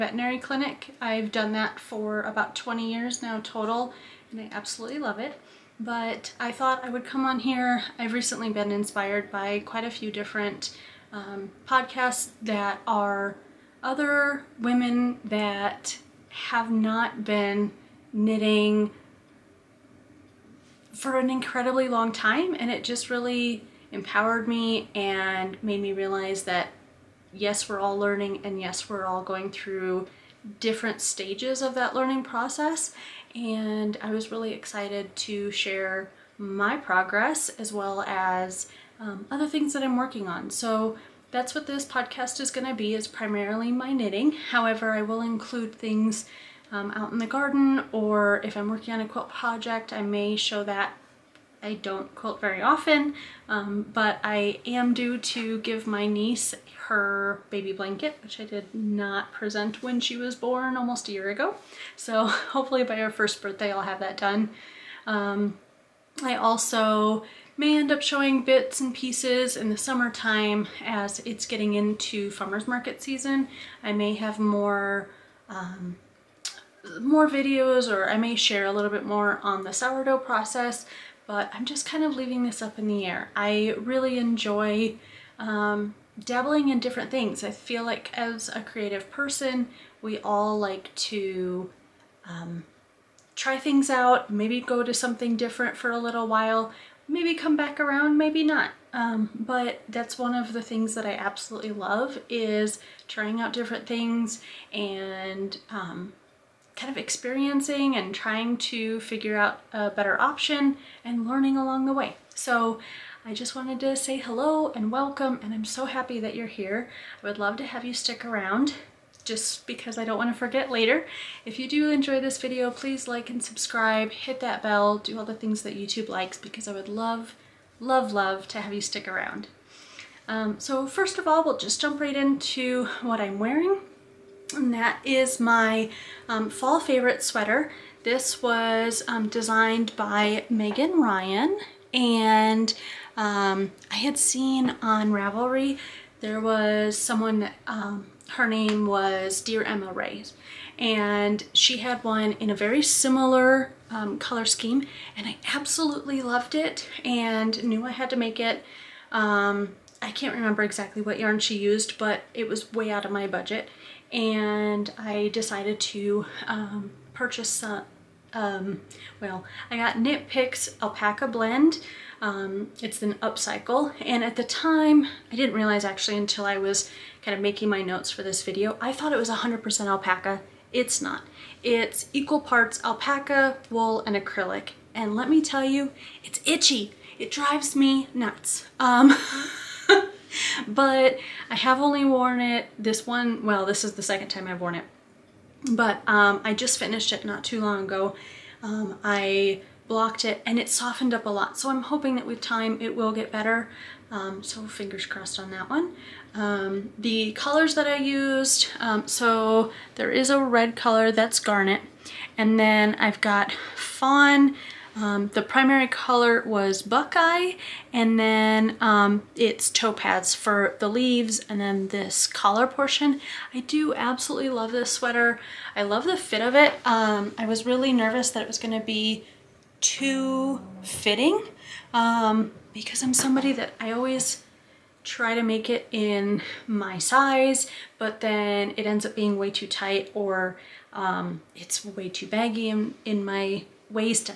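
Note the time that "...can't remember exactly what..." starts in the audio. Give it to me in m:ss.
2:40.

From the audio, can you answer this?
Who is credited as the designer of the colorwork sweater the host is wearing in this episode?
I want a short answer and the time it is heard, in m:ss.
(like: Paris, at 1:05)
Meghan Regan, at 2:20.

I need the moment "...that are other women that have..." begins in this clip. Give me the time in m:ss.
0:12.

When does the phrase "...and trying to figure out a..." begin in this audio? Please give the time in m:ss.
1:47.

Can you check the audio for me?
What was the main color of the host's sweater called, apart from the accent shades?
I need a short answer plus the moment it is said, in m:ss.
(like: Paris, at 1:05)
Buckeye, at 3:36.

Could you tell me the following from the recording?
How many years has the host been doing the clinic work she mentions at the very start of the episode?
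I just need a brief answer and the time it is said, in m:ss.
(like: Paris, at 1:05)
20 years, at 0:02.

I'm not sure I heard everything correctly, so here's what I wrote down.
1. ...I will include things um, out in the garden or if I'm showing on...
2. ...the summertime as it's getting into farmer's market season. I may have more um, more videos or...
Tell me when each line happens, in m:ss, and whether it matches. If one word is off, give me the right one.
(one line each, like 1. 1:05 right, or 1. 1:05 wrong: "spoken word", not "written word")
1. 0:44 wrong: "working", not "showing"
2. 1:09 right.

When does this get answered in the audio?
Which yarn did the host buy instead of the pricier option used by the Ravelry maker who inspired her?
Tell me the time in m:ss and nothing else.
2:49.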